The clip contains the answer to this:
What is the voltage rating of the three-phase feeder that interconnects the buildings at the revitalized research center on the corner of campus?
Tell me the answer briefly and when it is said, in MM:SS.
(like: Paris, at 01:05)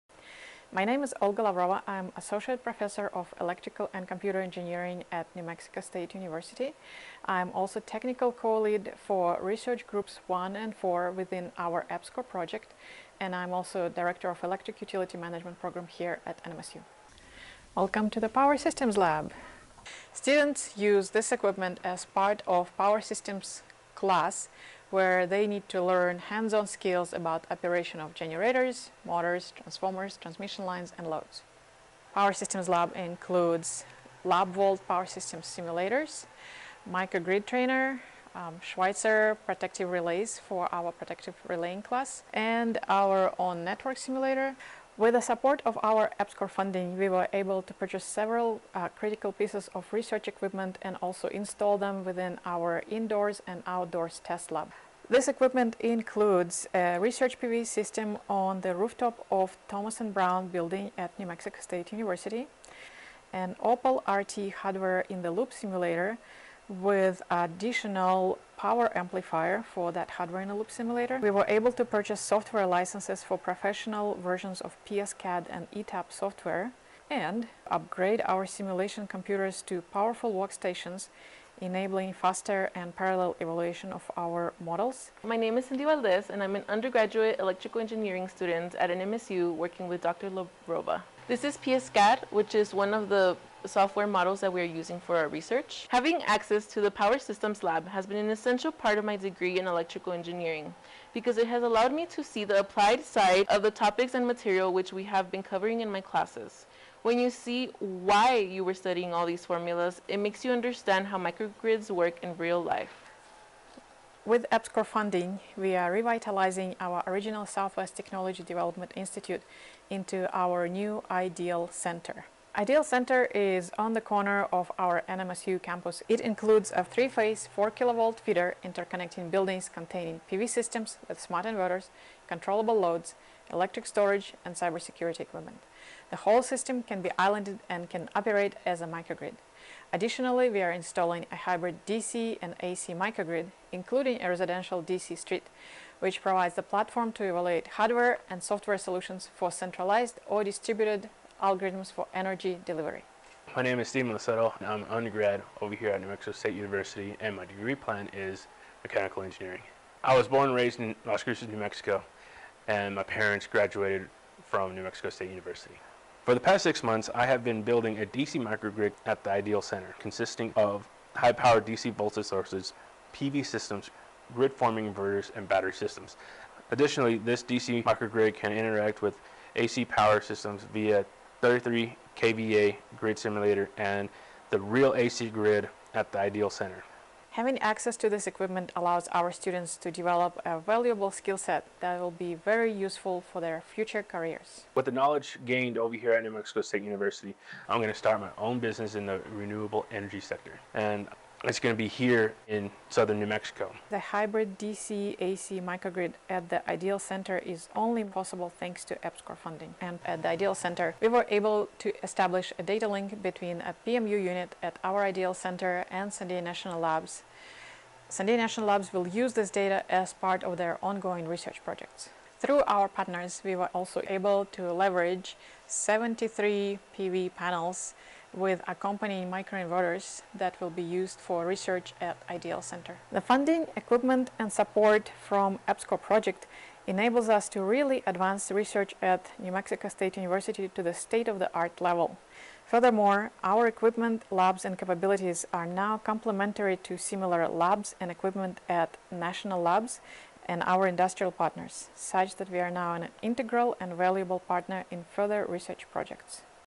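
4 kilovolt, at 02:07.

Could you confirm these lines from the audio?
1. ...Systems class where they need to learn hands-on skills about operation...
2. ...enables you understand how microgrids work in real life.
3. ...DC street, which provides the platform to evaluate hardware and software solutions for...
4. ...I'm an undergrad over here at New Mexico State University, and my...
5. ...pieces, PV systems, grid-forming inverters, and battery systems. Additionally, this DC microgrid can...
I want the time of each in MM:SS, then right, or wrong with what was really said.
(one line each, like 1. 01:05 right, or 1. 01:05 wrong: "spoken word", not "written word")
1. 00:23 right
2. 01:50 wrong: "makes", not "enables"
3. 02:24 right
4. 02:34 right
5. 02:52 wrong: "sources", not "pieces".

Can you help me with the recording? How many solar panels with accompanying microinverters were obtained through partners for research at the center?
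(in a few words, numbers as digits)
73.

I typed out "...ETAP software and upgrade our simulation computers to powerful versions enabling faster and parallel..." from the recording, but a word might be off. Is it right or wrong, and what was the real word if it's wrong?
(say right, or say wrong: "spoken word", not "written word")
wrong: "workstations", not "versions".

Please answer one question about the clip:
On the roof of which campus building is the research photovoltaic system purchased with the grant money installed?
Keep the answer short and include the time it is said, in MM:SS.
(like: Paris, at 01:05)
Thomas and Brown, at 00:59.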